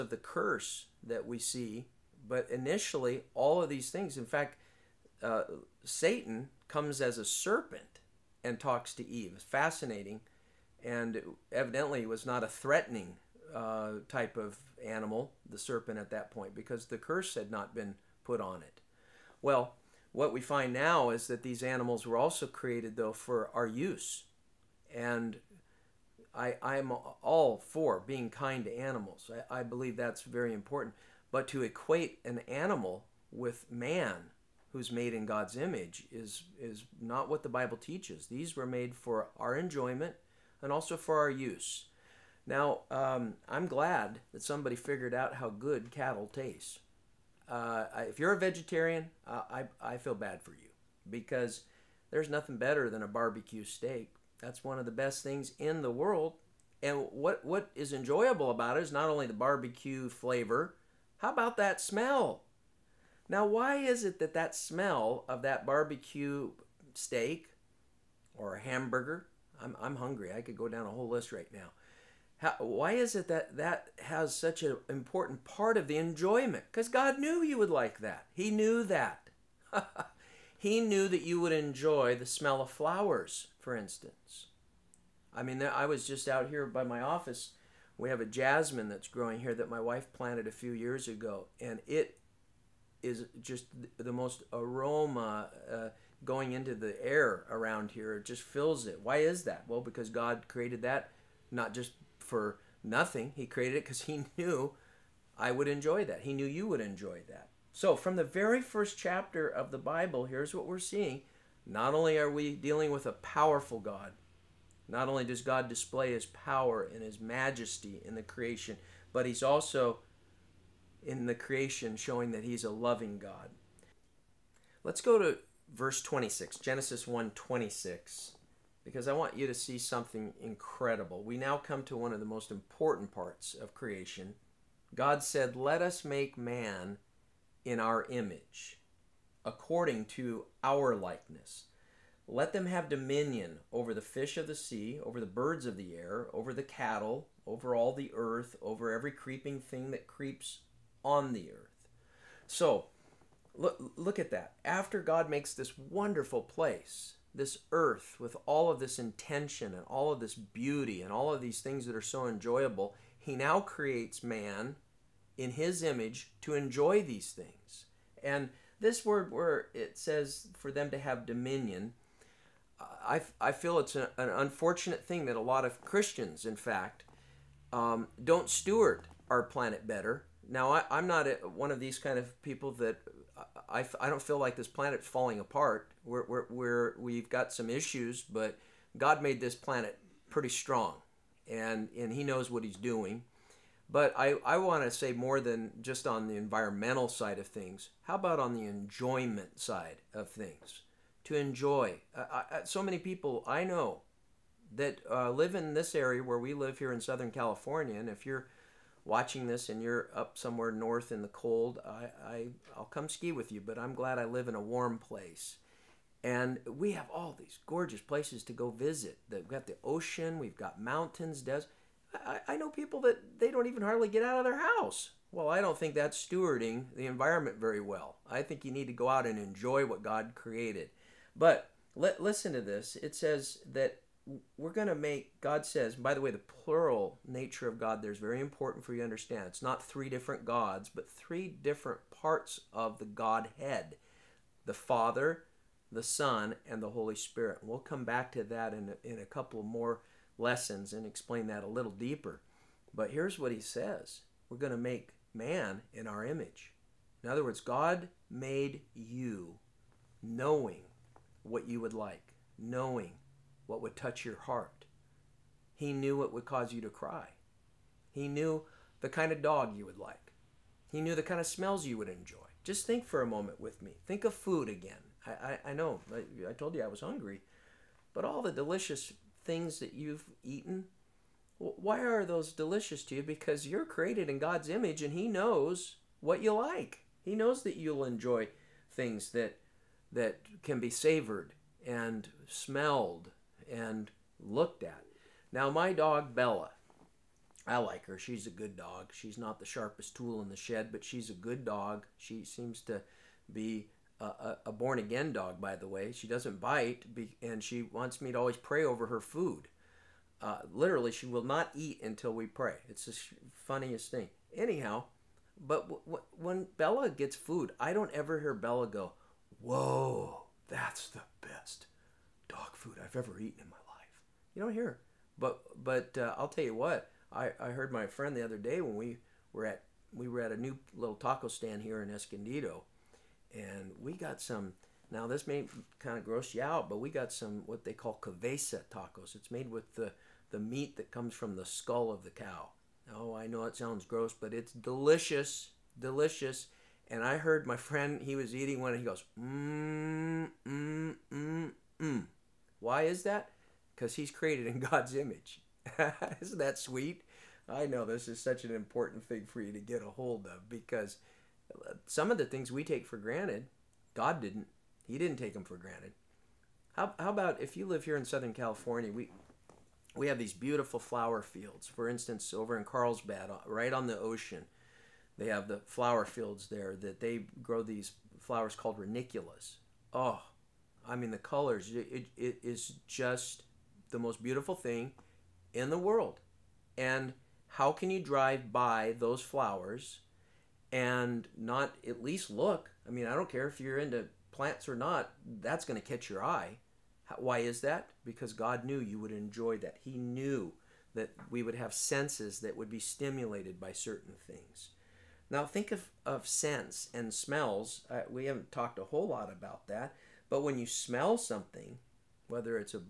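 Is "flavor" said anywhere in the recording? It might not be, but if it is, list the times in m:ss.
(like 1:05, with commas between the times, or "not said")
1:00.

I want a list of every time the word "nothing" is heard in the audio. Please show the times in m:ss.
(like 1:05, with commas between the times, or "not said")
0:52, 1:42.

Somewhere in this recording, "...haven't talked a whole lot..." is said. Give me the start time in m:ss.
6:48.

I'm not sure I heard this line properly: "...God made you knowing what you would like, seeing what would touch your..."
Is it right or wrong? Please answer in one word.
wrong.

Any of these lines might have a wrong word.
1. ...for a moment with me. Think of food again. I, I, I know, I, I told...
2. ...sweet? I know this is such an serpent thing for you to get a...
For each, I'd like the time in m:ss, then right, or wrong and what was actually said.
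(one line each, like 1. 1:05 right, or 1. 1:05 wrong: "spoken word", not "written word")
1. 4:33 right
2. 5:56 wrong: "important", not "serpent".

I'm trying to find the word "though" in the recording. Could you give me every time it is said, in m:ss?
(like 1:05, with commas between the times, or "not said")
0:22.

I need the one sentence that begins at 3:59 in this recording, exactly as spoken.
It's not three different gods, but three different parts of the Godhead the Father, the Son, and the Holy Spirit.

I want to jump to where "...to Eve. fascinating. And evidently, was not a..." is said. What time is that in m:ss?
0:08.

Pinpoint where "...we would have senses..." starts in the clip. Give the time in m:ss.
6:41.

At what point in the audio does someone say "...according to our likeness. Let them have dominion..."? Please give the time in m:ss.
2:19.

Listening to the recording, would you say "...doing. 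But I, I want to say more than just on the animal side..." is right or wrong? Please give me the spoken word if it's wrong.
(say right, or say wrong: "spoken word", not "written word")
wrong: "environmental", not "animal".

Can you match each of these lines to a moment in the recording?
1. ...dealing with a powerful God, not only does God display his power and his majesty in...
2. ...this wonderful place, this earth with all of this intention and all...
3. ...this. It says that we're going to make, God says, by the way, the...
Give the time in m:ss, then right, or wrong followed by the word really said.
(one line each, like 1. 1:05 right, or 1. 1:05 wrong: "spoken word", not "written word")
1. 1:52 right
2. 2:35 right
3. 3:52 right.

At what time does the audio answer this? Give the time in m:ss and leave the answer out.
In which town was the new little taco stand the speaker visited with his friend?
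5:32.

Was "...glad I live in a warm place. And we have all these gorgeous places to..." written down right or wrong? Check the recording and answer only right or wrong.
right.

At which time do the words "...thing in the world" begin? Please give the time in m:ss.
6:24.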